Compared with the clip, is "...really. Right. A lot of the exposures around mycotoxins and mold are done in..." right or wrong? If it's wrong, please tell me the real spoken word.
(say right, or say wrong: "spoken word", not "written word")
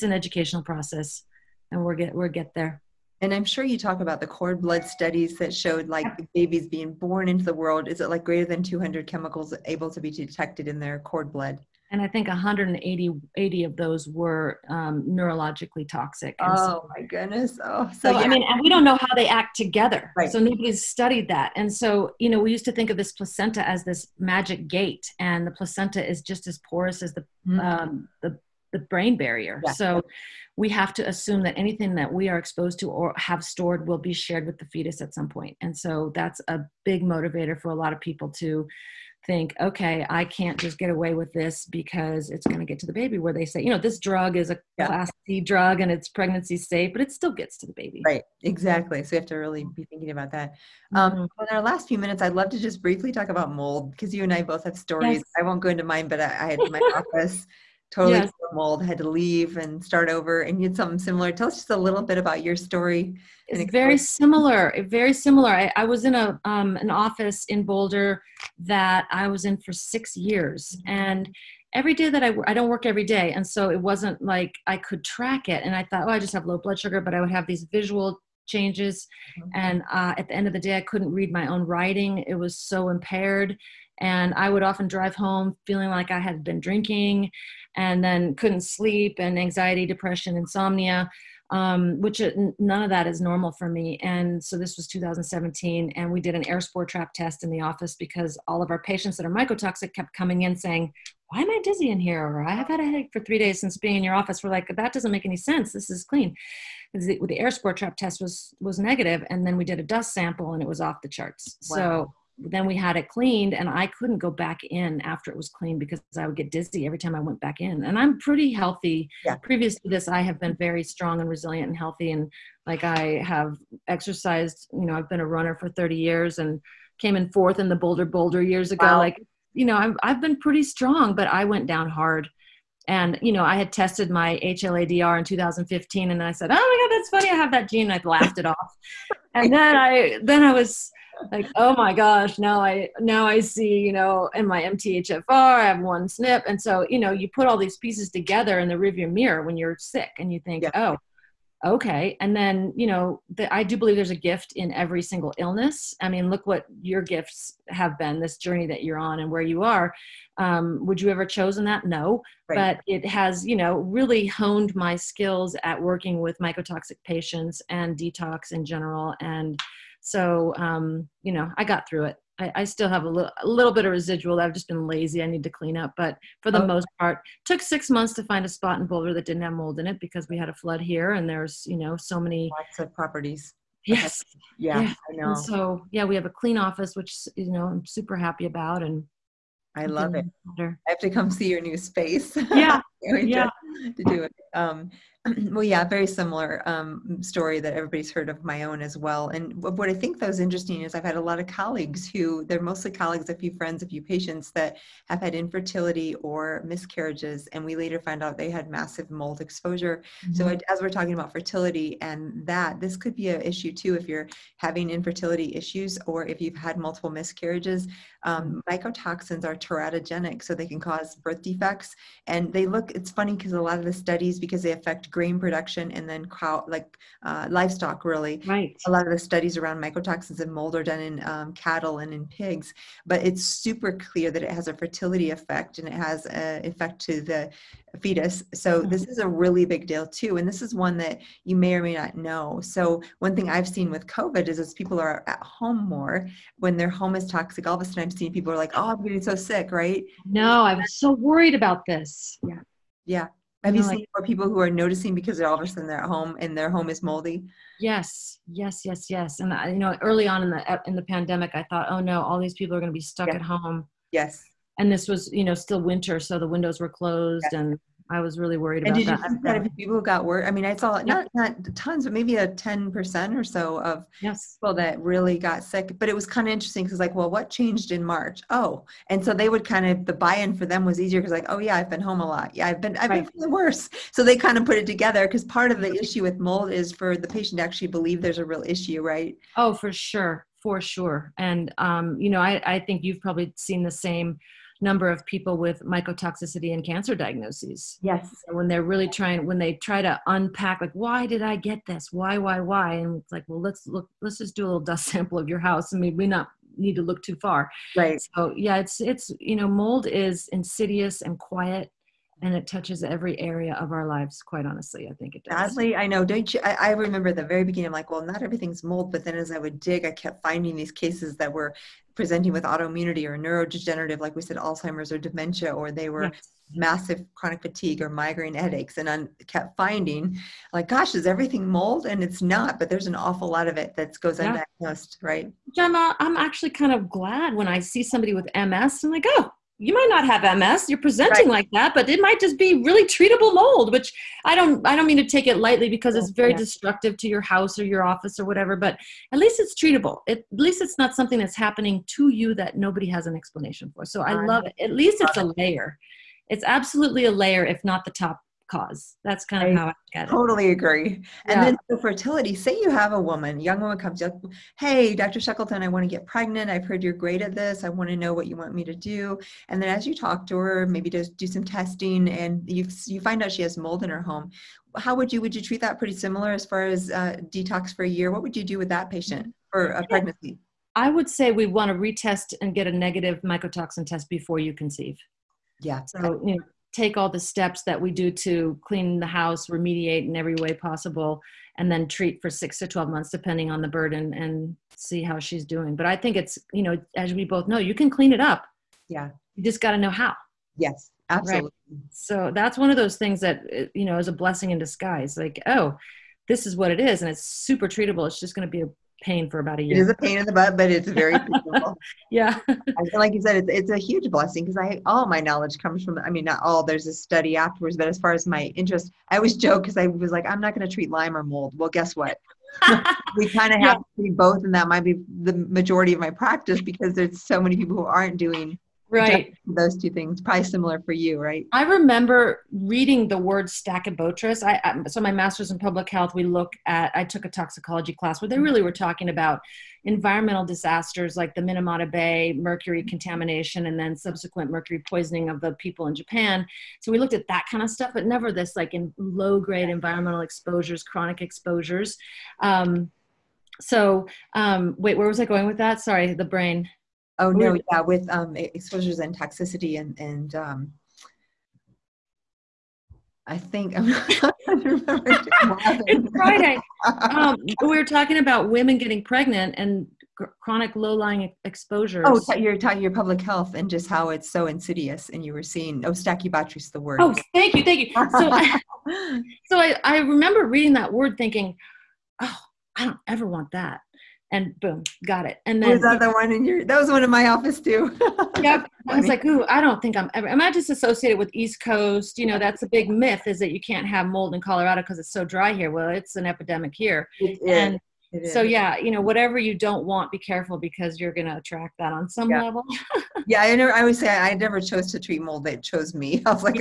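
wrong: "studies", not "exposures".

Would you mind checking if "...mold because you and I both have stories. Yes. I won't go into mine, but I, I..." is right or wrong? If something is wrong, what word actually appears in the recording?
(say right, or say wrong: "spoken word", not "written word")
right.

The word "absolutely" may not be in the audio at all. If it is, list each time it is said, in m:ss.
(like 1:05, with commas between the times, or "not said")
5:56, 6:41.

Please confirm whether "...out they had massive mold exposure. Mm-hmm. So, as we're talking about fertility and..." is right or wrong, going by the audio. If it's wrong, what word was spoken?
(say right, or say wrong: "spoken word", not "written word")
right.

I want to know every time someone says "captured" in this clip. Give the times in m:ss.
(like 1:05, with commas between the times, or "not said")
not said.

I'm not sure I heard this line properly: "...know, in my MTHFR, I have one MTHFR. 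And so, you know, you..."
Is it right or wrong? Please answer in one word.
wrong.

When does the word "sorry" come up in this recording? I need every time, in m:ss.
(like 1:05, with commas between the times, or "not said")
7:36.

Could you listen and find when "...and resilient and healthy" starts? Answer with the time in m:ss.
2:01.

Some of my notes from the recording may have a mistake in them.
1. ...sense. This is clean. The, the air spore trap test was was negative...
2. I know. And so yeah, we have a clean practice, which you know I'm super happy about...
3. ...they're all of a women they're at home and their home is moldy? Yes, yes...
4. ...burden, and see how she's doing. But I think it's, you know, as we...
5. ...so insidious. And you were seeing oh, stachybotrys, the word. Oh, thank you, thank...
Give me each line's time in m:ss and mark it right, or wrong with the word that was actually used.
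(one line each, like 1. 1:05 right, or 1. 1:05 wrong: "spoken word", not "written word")
1. 1:45 right
2. 3:05 wrong: "office", not "practice"
3. 4:15 wrong: "sudden", not "women"
4. 6:33 right
5. 7:54 right.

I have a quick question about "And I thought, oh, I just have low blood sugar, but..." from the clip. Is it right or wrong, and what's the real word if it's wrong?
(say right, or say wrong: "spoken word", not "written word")
right.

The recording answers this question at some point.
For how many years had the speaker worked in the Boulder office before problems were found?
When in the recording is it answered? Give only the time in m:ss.
1:09.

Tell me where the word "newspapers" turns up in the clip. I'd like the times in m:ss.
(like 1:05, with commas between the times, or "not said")
not said.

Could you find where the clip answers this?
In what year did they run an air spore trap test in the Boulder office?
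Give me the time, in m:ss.
1:34.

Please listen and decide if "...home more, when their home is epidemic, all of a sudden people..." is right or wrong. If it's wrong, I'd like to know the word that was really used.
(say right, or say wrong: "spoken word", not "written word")
wrong: "toxic", not "epidemic".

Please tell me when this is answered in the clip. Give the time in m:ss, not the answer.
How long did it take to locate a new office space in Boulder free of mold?
2:57.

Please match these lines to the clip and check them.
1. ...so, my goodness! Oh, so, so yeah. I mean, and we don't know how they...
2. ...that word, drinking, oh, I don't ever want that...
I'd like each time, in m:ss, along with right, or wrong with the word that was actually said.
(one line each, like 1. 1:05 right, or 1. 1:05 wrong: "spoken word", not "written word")
1. 0:16 right
2. 8:00 wrong: "thinking", not "drinking".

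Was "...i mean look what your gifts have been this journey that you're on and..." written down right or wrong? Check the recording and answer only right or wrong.
right.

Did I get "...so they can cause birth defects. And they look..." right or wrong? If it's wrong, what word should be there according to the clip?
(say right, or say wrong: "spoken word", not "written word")
right.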